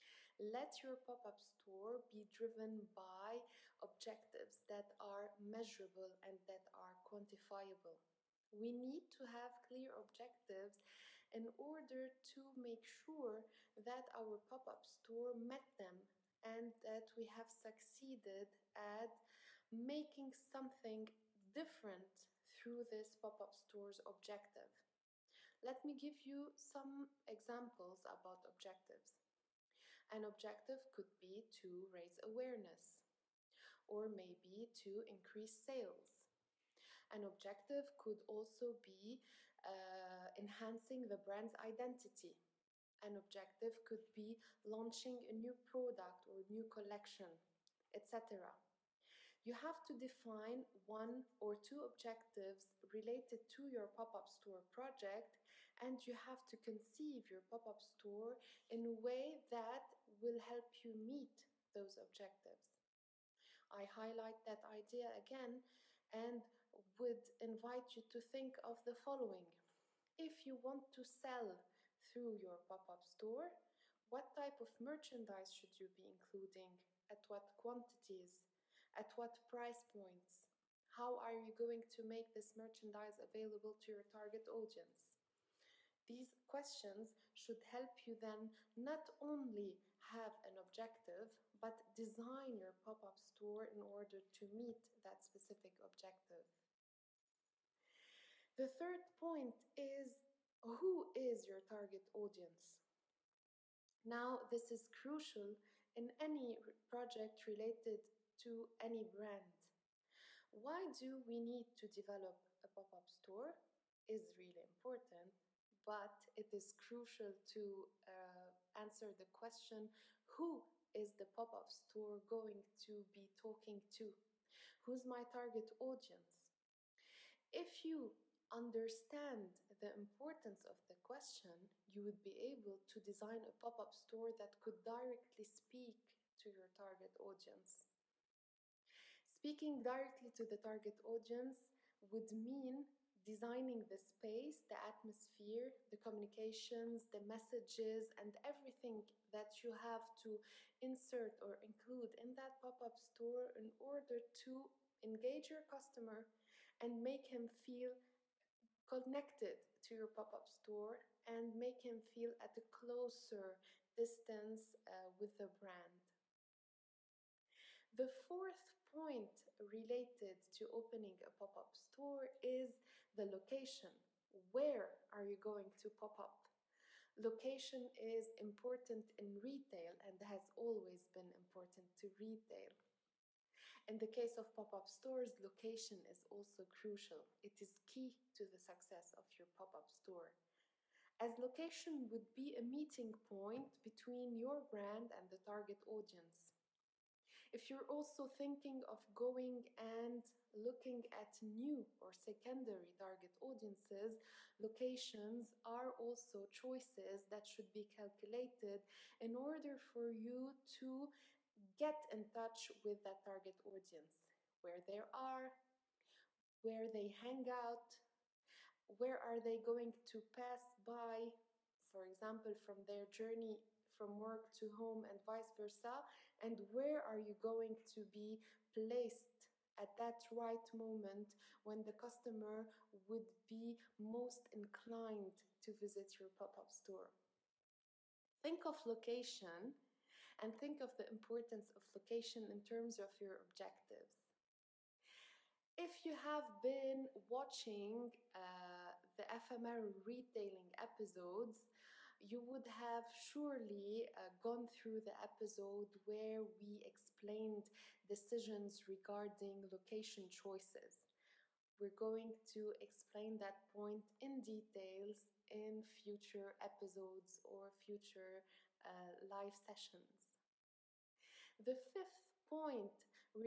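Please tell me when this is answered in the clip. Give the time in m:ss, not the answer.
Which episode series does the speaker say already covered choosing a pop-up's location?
4:09.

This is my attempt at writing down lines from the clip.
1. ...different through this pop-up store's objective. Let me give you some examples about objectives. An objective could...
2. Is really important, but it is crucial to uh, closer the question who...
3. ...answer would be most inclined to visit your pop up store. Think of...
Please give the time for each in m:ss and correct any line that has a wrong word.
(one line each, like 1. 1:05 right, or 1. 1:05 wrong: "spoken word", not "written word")
1. 0:21 right
2. 1:54 wrong: "answer", not "closer"
3. 3:51 wrong: "customer", not "answer".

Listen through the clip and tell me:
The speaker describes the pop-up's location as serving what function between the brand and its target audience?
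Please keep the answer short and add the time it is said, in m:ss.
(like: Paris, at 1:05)
A meeting point, at 3:12.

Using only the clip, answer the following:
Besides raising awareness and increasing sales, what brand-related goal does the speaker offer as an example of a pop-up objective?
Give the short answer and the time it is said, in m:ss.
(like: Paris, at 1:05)
Enhancing the brand's identity, at 0:40.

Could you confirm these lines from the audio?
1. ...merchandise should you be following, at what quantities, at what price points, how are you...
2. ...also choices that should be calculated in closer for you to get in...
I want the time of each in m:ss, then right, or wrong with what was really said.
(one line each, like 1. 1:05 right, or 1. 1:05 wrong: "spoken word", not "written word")
1. 1:14 wrong: "including", not "following"
2. 3:25 wrong: "order", not "closer".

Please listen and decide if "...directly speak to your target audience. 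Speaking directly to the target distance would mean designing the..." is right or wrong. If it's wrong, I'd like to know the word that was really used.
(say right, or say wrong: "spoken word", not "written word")
wrong: "audience", not "distance".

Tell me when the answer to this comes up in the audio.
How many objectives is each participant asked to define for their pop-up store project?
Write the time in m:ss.
0:50.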